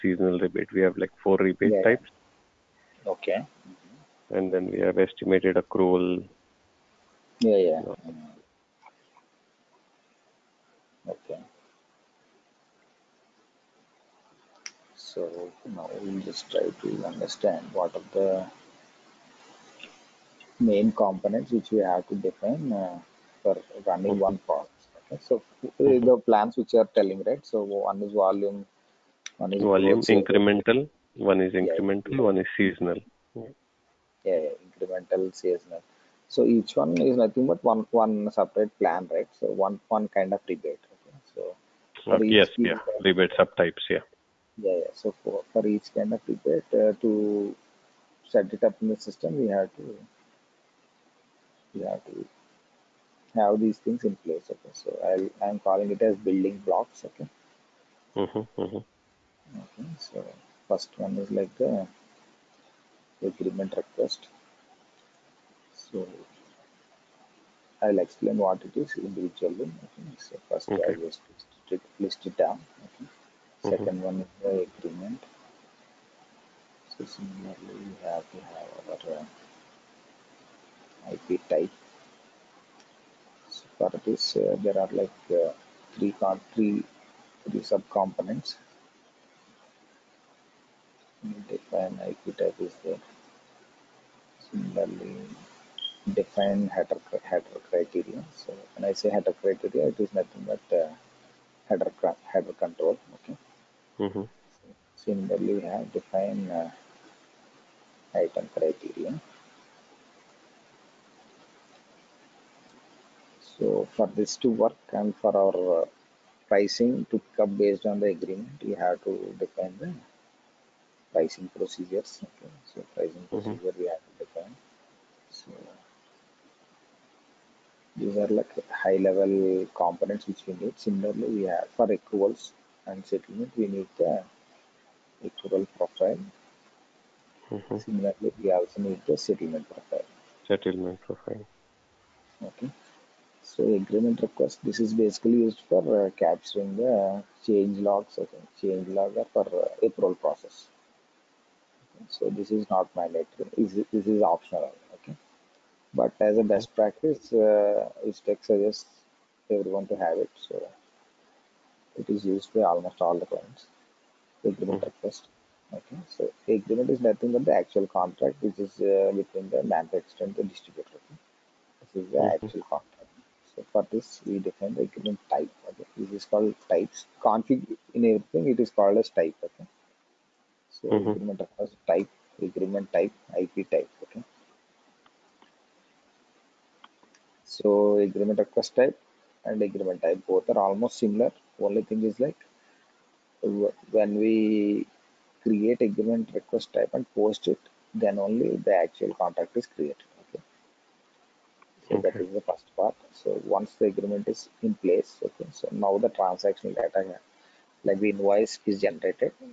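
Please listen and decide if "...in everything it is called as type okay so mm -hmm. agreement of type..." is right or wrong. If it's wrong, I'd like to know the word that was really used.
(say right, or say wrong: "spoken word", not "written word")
right.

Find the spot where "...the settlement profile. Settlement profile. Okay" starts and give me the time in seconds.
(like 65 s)
139 s.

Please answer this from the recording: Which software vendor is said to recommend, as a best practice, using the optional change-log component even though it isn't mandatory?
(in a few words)
Vistex.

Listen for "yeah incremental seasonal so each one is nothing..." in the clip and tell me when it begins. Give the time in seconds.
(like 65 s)
34 s.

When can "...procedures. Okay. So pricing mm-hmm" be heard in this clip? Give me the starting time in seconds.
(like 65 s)
121 s.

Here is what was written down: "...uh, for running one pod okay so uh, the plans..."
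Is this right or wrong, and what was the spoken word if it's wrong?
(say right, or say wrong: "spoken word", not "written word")
right.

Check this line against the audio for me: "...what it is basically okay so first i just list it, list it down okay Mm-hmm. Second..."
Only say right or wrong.
wrong.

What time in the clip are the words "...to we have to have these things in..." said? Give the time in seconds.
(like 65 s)
49 s.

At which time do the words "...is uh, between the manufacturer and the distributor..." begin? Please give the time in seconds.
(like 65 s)
168 s.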